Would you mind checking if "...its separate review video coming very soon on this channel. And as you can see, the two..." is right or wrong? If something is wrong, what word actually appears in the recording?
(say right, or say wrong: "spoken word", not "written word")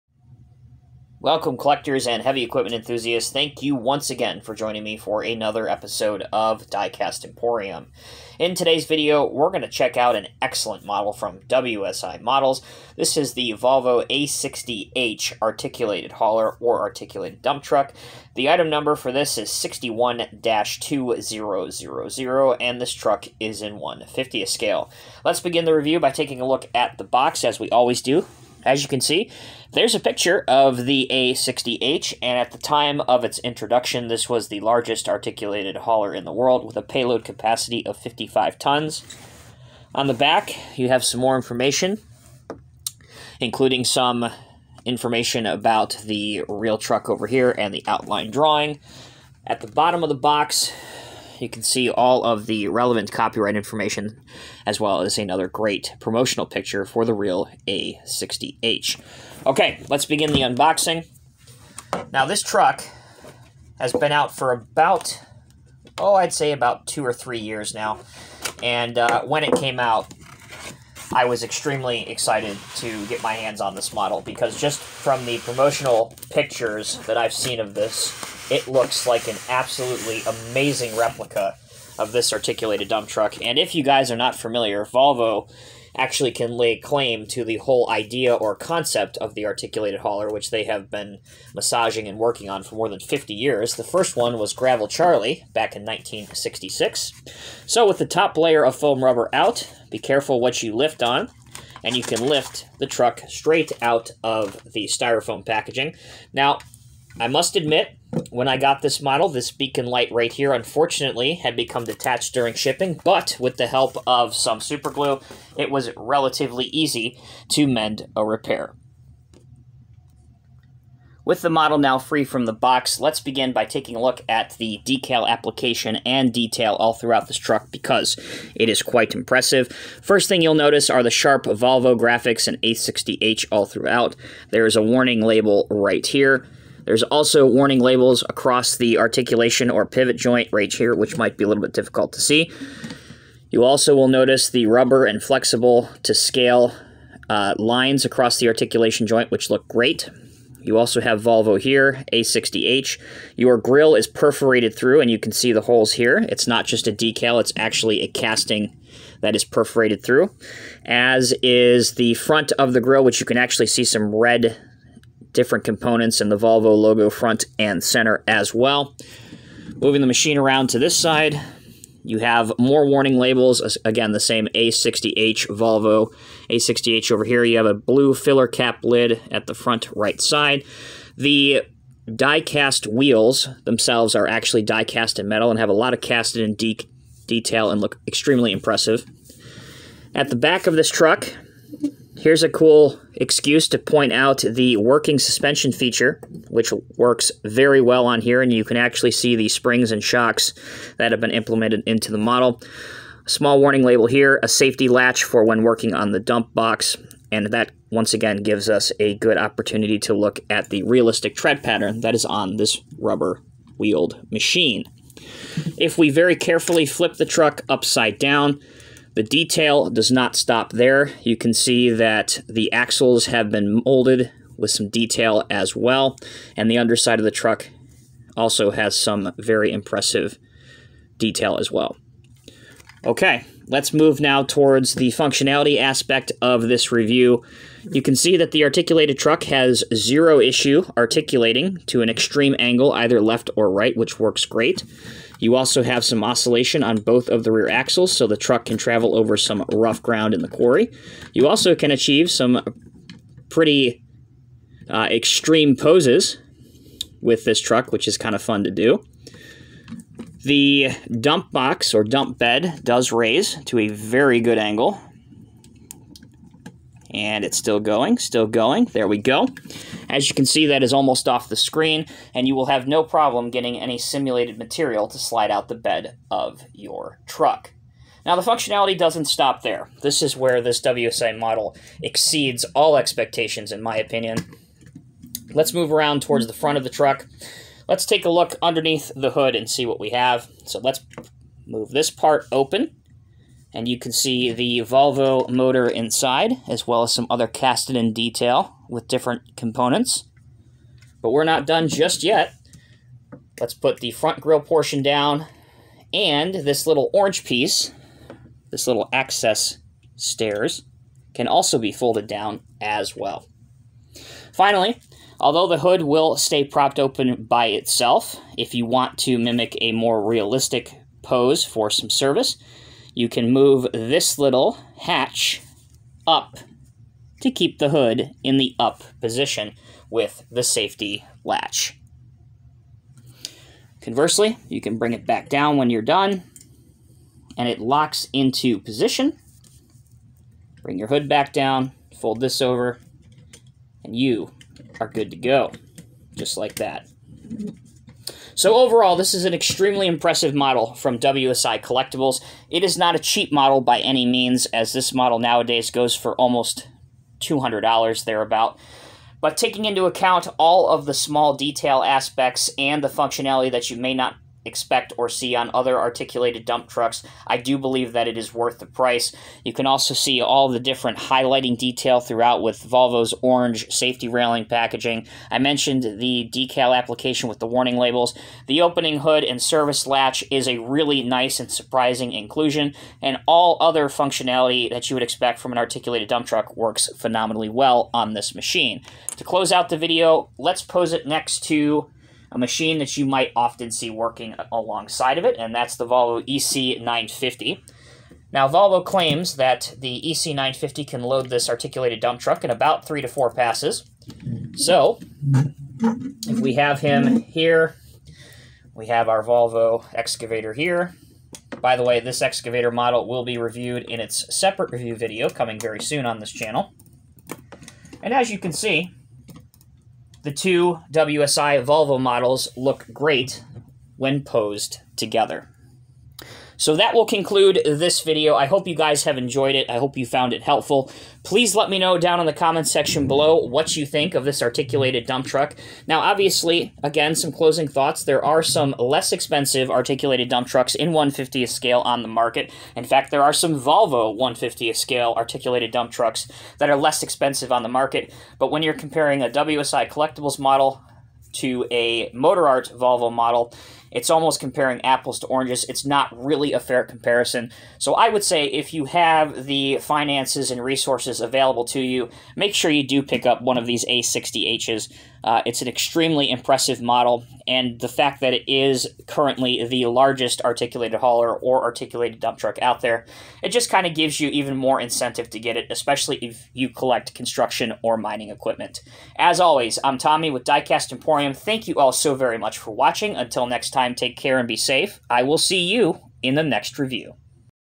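right.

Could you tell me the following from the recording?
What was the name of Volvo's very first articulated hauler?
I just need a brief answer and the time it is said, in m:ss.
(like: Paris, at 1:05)
Gravel Charlie, at 1:34.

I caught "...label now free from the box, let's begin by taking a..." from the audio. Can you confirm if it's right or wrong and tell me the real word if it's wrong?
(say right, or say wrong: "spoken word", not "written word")
wrong: "model", not "label".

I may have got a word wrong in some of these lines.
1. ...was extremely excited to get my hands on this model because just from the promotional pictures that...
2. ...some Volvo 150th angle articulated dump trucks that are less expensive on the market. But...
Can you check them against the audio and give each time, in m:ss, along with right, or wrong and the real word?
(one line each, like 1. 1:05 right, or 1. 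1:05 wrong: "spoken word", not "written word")
1. 1:11 right
2. 7:23 wrong: "scale", not "angle".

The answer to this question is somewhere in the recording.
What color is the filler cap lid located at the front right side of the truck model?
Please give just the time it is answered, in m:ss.
2:57.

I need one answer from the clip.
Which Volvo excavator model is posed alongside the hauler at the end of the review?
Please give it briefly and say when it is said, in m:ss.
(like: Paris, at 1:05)
Volvo EC950, at 6:36.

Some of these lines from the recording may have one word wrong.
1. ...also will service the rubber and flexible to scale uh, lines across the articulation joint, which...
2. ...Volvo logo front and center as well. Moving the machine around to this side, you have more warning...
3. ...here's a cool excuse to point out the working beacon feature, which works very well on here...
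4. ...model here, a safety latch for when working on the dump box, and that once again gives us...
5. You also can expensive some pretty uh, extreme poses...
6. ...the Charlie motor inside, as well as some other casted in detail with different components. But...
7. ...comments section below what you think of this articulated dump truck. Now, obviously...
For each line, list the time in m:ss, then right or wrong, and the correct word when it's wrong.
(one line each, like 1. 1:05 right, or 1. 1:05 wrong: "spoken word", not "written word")
1. 2:23 wrong: "notice", not "service"
2. 2:46 right
3. 3:12 wrong: "suspension", not "beacon"
4. 3:23 wrong: "label", not "model"
5. 4:11 wrong: "achieve", not "expensive"
6. 4:54 wrong: "Volvo", not "Charlie"
7. 7:12 right.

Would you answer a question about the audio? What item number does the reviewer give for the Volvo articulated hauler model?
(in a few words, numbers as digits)
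61-2000.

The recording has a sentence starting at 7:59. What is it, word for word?
As always, I'm Tommy with Diecast Emporium.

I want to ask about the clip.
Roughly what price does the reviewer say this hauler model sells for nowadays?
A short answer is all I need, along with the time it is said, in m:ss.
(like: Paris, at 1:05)
almost $200, at 5:56.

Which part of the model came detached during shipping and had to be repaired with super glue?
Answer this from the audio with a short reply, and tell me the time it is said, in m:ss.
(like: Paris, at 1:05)
beacon light, at 1:49.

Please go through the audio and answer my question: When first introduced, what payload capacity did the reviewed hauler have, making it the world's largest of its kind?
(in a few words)
55 tons.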